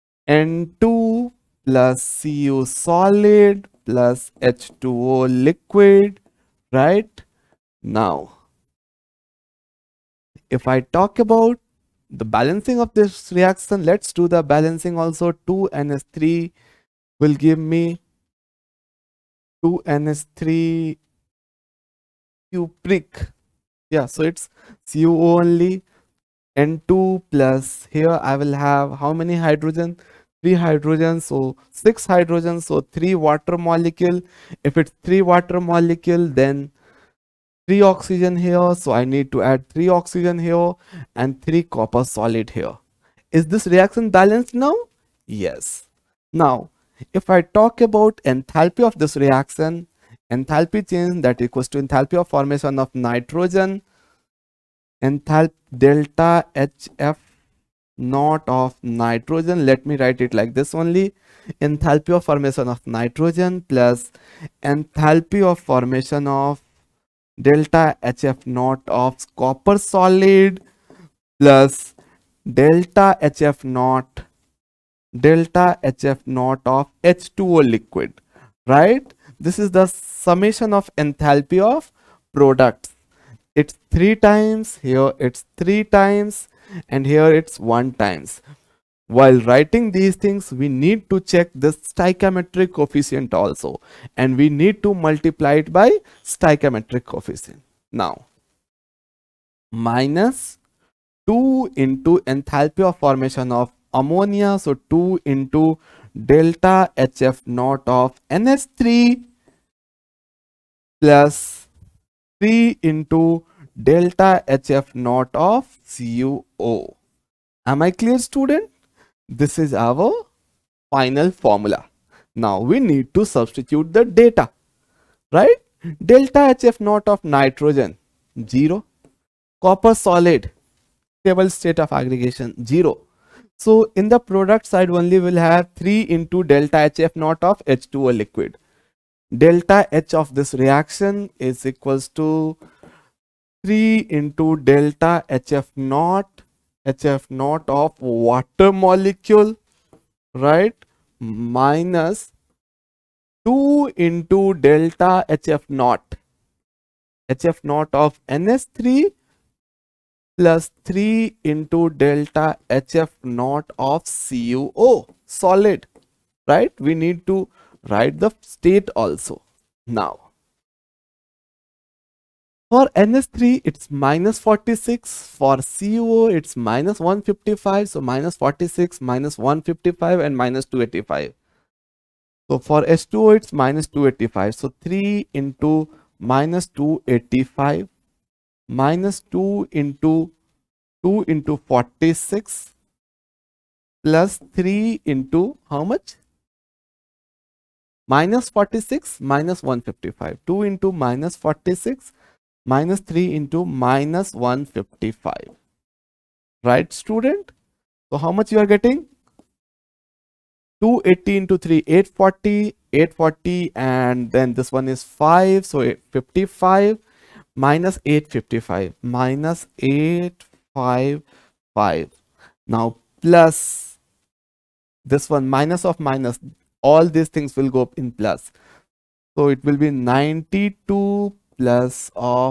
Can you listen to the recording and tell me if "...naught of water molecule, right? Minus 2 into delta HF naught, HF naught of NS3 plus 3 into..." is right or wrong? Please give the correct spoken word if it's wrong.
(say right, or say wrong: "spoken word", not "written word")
right.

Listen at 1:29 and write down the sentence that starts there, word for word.
While writing these things, we need to check this stoichiometric coefficient also, and we need to multiply it by stoichiometric coefficient.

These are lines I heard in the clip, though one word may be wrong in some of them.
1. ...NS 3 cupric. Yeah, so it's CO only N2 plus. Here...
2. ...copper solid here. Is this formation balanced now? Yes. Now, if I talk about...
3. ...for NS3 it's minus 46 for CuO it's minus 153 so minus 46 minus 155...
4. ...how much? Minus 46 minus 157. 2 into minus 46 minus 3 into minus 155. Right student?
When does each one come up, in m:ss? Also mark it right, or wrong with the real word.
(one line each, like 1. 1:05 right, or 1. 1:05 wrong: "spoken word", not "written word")
1. 0:19 right
2. 0:41 wrong: "reaction", not "formation"
3. 2:52 wrong: "155", not "153"
4. 3:15 wrong: "155", not "157".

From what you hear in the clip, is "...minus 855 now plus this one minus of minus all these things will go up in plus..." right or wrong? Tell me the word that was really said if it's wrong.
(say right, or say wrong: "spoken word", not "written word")
right.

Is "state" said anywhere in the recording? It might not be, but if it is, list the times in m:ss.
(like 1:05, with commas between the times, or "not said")
2:11, 2:48.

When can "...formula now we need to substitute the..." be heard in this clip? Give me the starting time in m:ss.
2:01.